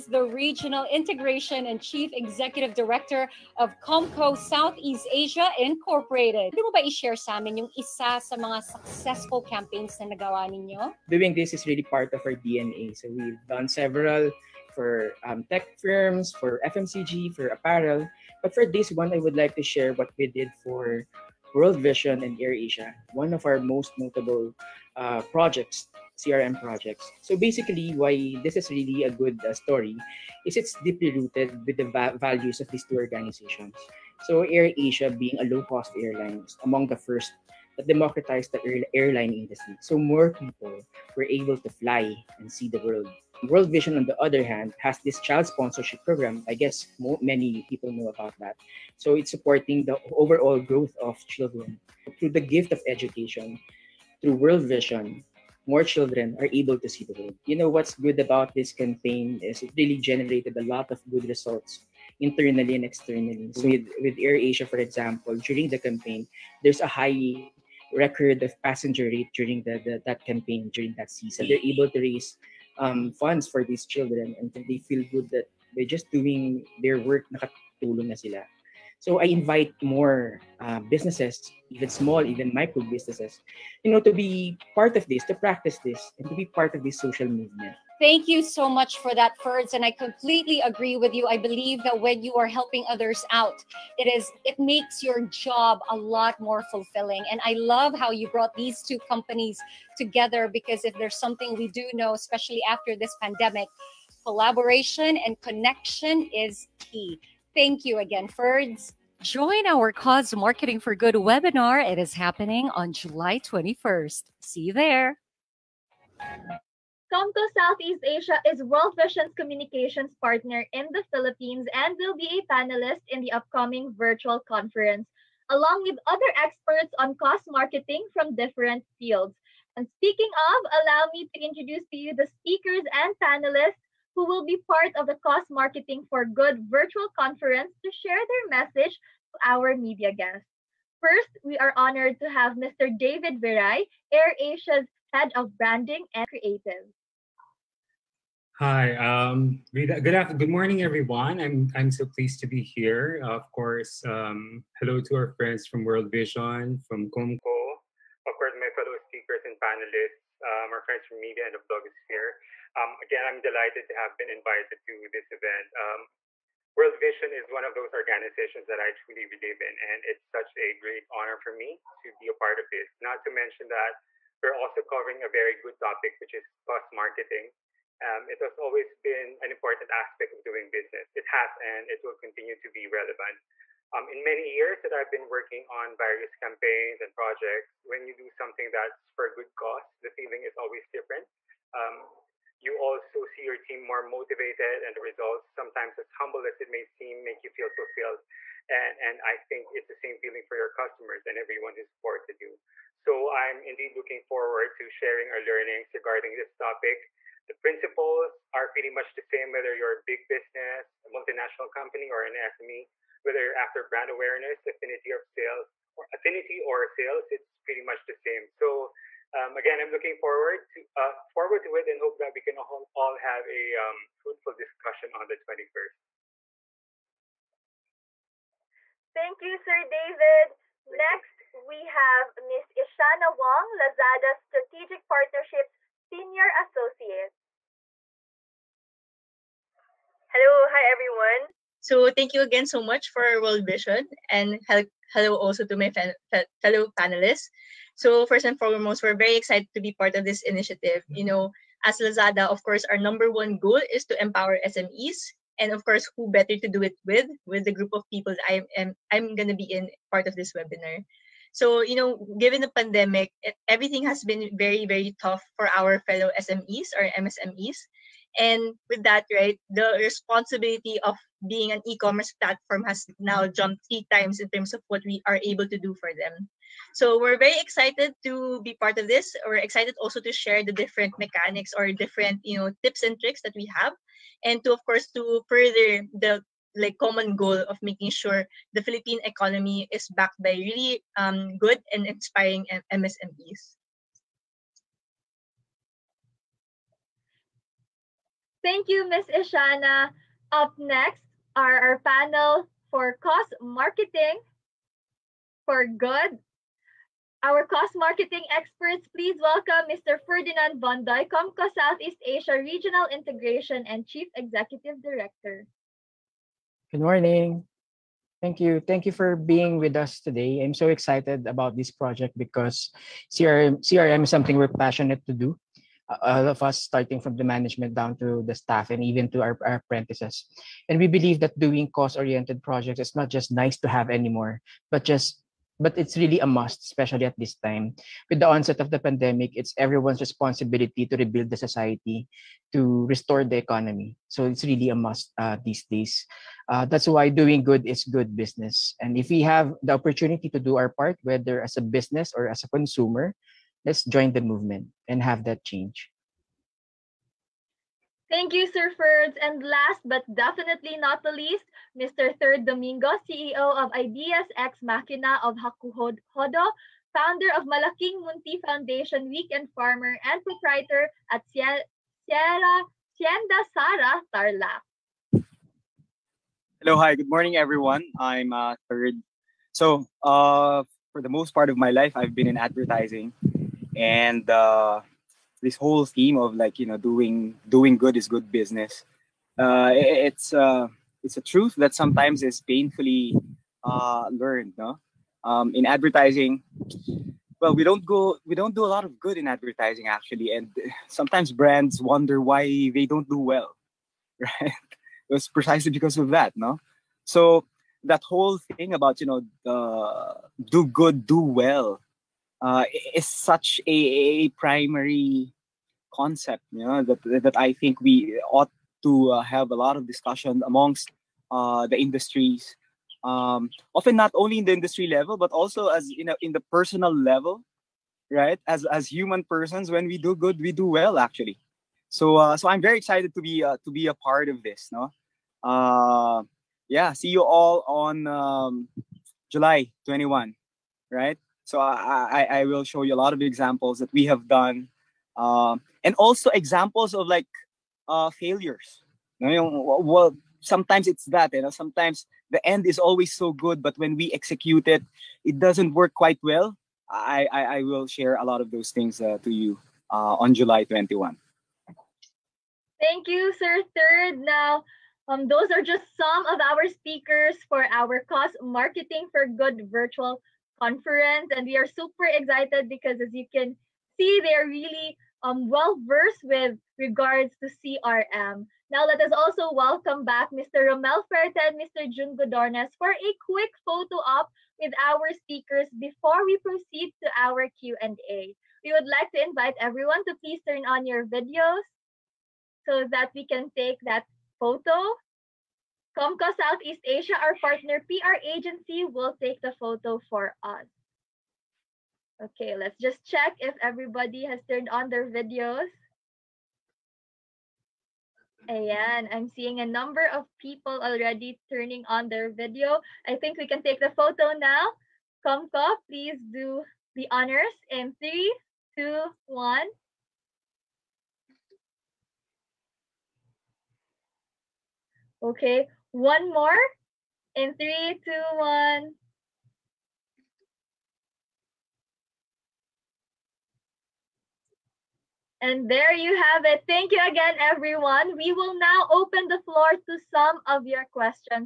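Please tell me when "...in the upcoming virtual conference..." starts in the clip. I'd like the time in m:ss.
2:03.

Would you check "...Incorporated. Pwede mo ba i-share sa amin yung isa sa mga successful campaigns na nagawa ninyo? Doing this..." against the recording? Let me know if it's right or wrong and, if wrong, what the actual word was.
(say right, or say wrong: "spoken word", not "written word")
right.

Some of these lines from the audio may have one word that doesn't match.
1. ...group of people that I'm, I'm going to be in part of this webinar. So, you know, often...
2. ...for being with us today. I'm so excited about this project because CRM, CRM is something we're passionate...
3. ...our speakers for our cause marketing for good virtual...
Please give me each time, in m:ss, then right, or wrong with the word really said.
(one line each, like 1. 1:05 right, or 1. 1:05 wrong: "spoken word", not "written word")
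1. 4:17 wrong: "given", not "often"
2. 5:19 right
3. 7:46 right.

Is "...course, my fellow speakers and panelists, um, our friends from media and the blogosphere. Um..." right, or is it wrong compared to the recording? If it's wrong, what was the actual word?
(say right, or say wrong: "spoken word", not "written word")
right.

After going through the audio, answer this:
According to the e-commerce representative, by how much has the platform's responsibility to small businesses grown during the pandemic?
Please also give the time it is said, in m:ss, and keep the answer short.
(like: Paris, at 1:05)
three times, at 4:33.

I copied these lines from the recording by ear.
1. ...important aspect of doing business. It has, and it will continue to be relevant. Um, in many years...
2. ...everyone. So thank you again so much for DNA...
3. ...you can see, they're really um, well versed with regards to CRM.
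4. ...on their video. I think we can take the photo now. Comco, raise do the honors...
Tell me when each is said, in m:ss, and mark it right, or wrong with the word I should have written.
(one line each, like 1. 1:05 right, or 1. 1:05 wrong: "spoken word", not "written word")
1. 2:59 right
2. 4:00 wrong: "World", not "DNA"
3. 7:53 right
4. 8:32 wrong: "please", not "raise".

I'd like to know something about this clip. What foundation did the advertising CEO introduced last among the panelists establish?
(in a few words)
Malaking Munti Foundation.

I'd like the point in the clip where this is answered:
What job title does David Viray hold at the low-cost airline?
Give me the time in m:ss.
2:25.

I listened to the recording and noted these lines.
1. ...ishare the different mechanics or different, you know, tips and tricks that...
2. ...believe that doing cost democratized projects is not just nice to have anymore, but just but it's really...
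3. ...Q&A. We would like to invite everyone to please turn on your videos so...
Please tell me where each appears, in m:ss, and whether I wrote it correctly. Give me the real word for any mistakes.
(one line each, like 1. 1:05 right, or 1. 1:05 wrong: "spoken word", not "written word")
1. 4:40 wrong: "share", not "ishare"
2. 5:31 wrong: "oriented", not "democratized"
3. 8:07 right.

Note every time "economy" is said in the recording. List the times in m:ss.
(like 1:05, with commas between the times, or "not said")
4:49, 5:43.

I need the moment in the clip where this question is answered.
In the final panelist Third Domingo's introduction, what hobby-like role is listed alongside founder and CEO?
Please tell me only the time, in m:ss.
6:09.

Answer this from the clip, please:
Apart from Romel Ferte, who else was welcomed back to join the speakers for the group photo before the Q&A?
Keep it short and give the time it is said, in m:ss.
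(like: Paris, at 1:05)
Jun Godornes, at 8:02.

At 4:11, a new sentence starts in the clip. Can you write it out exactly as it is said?
You know, as Lazada, of course, our number one goal is to empower SMEs.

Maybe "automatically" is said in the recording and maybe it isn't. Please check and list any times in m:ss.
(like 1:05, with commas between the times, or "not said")
not said.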